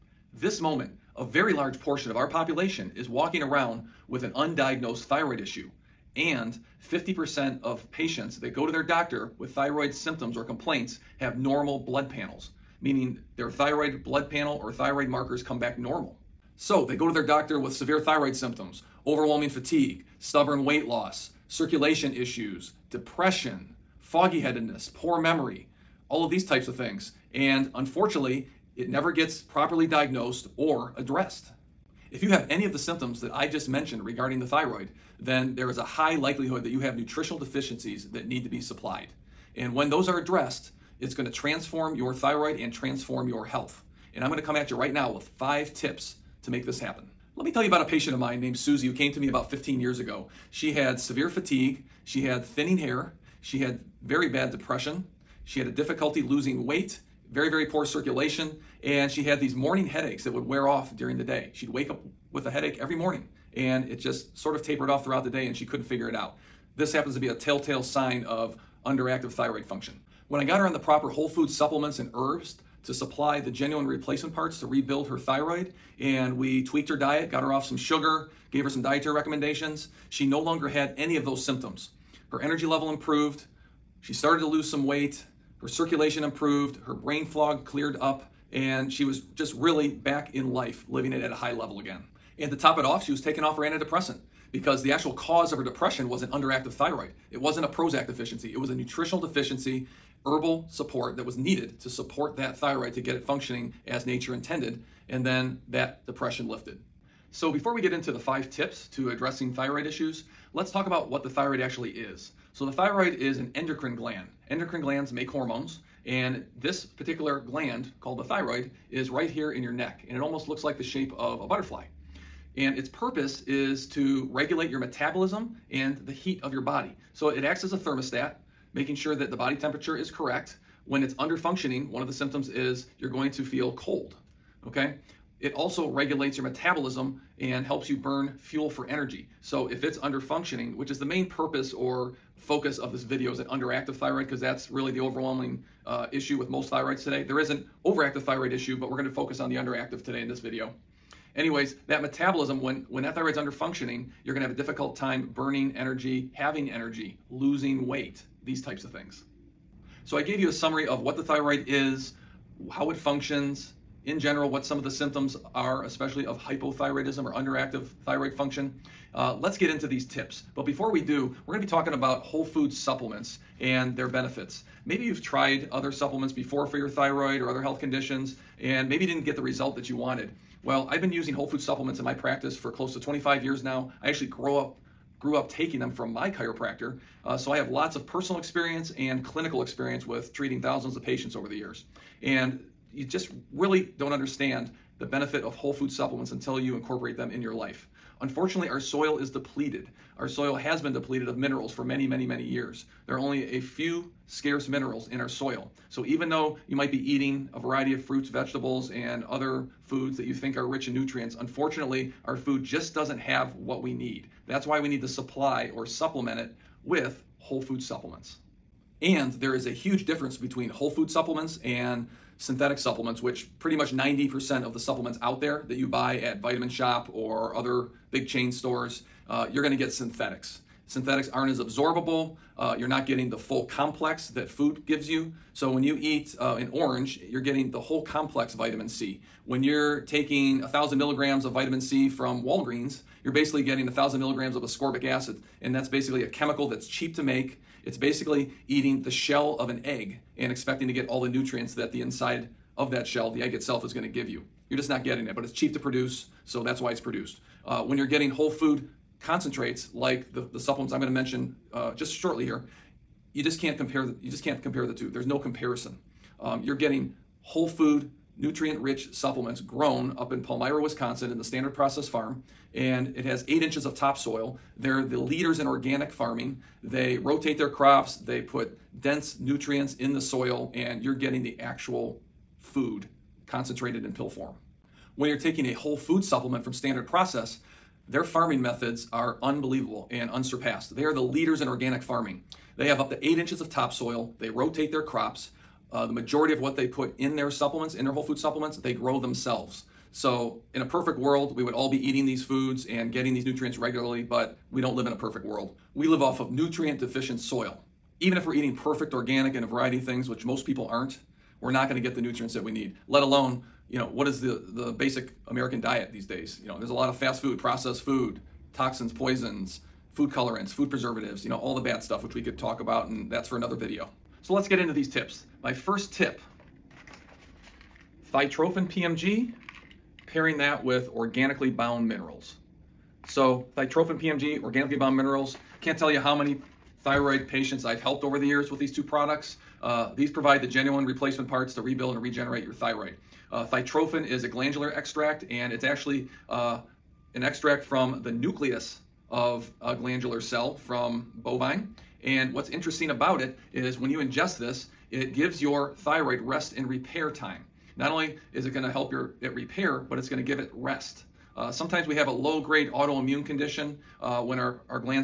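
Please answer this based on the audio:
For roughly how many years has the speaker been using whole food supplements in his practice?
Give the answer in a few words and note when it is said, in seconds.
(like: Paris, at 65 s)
25 years, at 182 s.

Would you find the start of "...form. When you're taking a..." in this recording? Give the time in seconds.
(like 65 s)
284 s.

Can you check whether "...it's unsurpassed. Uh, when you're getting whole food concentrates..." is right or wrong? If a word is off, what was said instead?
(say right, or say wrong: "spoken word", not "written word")
wrong: "produced", not "unsurpassed".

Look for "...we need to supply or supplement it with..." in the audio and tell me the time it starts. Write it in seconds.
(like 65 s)
214 s.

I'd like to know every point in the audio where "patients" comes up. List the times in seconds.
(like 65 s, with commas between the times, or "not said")
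7 s, 47 s, 191 s, 337 s.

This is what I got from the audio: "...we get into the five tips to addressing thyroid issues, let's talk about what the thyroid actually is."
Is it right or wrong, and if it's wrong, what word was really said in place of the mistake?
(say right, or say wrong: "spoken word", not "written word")
right.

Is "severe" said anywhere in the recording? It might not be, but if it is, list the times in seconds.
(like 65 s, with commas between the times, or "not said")
17 s, 50 s.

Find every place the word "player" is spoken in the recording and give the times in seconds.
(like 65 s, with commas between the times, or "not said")
not said.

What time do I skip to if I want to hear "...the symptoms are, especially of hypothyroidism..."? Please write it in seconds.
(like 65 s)
164 s.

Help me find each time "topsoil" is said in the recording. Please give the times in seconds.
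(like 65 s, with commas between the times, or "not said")
273 s, 293 s.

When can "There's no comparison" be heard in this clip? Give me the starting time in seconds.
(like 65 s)
265 s.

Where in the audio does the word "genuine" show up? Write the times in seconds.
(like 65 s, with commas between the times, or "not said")
73 s, 340 s.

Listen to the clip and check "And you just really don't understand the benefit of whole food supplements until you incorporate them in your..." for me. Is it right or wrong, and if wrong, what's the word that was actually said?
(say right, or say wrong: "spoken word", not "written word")
right.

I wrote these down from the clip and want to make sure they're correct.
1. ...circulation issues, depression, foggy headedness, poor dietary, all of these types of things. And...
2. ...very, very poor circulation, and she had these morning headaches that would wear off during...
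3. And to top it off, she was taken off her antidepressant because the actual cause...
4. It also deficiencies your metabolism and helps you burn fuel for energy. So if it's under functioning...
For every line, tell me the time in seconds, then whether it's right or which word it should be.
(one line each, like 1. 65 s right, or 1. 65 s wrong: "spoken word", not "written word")
1. 21 s wrong: "memory", not "dietary"
2. 57 s right
3. 92 s right
4. 135 s wrong: "regulates", not "deficiencies".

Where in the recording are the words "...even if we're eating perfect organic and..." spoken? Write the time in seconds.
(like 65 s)
308 s.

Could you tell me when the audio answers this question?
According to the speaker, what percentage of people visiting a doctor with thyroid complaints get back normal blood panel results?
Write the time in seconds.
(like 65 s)
6 s.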